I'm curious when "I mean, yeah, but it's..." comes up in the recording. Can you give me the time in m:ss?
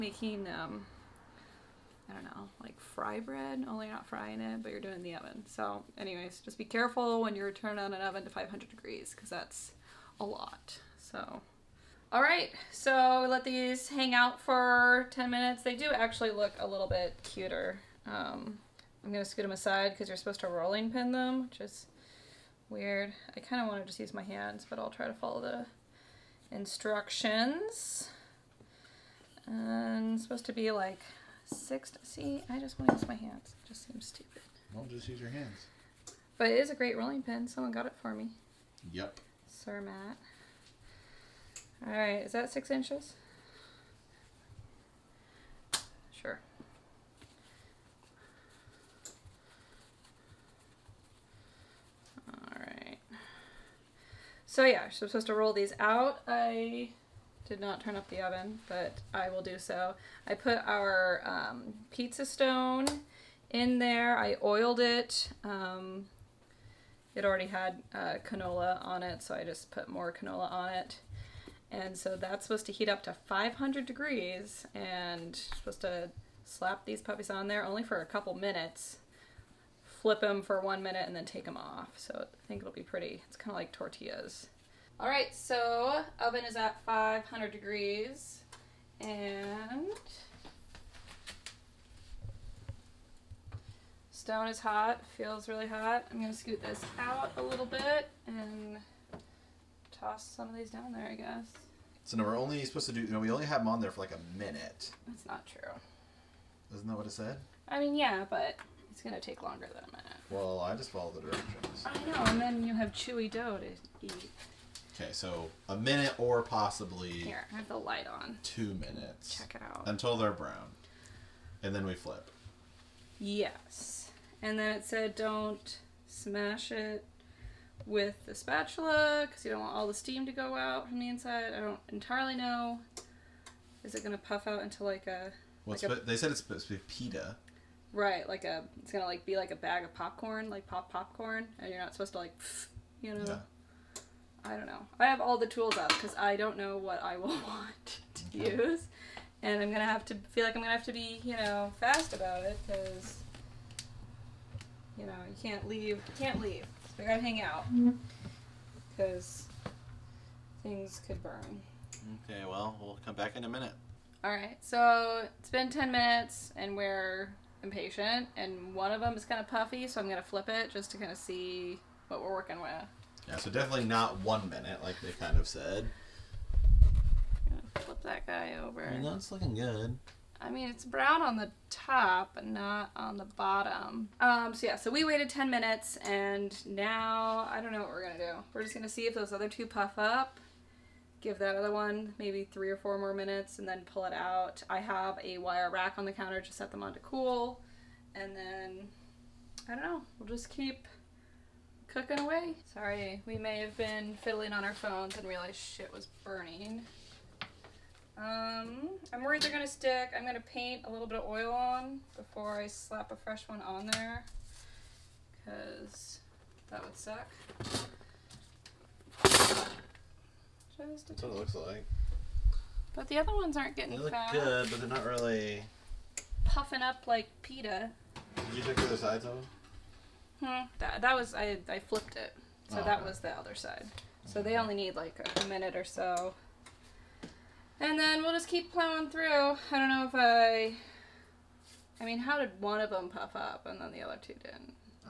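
1:47.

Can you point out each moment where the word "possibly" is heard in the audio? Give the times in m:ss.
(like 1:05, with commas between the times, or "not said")
1:56.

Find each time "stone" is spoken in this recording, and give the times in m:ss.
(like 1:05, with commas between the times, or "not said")
1:02, 1:34.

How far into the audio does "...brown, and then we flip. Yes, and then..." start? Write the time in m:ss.
2:00.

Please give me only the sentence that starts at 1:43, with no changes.
No, we only have them on there for like a minute.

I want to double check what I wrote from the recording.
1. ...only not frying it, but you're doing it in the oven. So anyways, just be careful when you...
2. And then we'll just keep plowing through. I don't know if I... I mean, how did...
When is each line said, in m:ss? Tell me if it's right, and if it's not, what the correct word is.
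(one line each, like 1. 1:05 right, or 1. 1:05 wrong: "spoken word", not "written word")
1. 0:03 right
2. 3:57 right.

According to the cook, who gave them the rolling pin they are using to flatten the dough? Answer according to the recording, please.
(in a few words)
Sir Matt.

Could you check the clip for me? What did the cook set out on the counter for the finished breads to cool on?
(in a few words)
a wire rack.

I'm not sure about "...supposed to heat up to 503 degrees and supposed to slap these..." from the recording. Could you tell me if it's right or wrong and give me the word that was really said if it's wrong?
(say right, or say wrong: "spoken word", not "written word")
wrong: "500", not "503".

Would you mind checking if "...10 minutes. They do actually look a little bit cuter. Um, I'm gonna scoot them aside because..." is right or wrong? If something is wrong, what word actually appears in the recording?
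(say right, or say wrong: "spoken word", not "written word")
right.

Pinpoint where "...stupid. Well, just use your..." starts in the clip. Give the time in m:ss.
0:34.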